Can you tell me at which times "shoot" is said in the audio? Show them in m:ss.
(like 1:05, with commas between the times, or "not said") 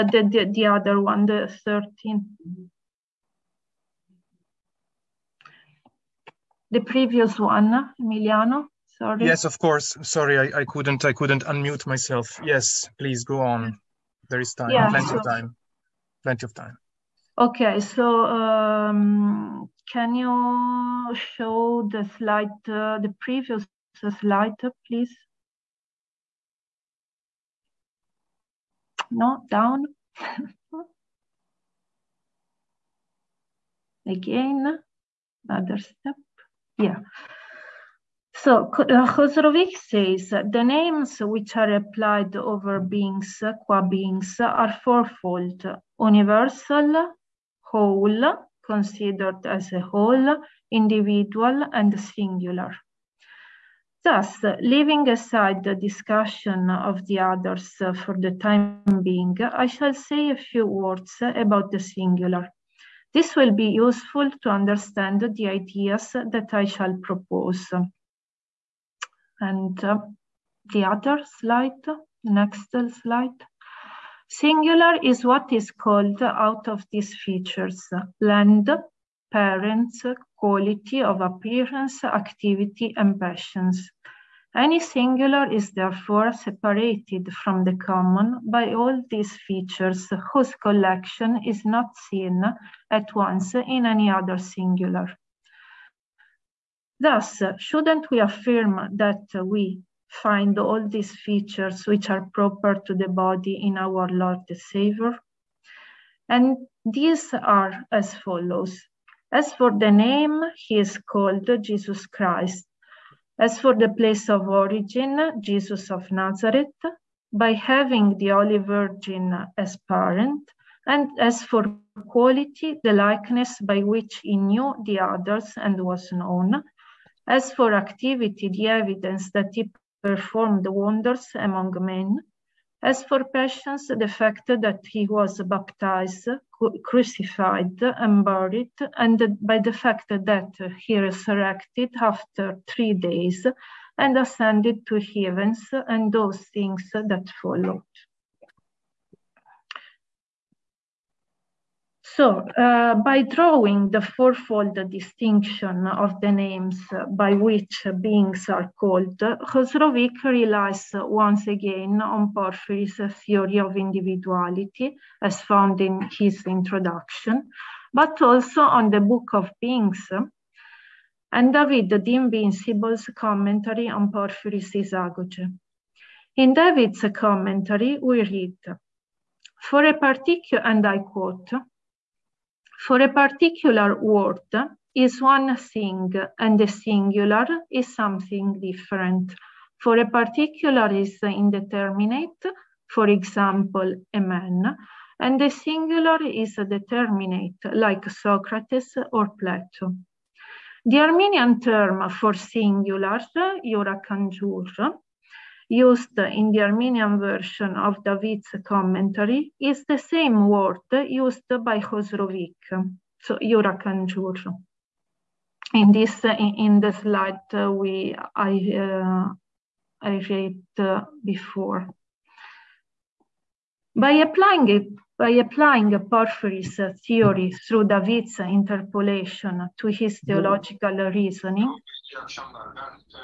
not said.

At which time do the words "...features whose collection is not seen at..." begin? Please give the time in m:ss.
1:29.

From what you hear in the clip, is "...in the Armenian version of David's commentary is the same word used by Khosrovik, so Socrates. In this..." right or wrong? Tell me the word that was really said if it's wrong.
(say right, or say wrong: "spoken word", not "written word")
wrong: "Yurakanjur", not "Socrates".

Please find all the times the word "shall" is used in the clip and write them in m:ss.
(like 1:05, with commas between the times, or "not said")
0:59, 1:06.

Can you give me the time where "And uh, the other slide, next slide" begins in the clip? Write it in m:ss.
1:09.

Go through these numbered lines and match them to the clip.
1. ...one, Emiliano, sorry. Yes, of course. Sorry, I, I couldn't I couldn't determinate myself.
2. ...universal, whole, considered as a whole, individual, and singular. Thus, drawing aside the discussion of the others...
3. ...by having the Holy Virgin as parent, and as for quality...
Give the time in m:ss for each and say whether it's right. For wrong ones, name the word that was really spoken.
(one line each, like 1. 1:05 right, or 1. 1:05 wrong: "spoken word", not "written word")
1. 0:07 wrong: "unmute", not "determinate"
2. 0:45 wrong: "leaving", not "drawing"
3. 1:57 right.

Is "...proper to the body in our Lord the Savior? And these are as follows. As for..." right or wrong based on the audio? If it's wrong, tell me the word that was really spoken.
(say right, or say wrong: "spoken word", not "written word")
right.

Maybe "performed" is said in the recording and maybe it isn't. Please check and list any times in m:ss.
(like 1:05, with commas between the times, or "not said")
2:10.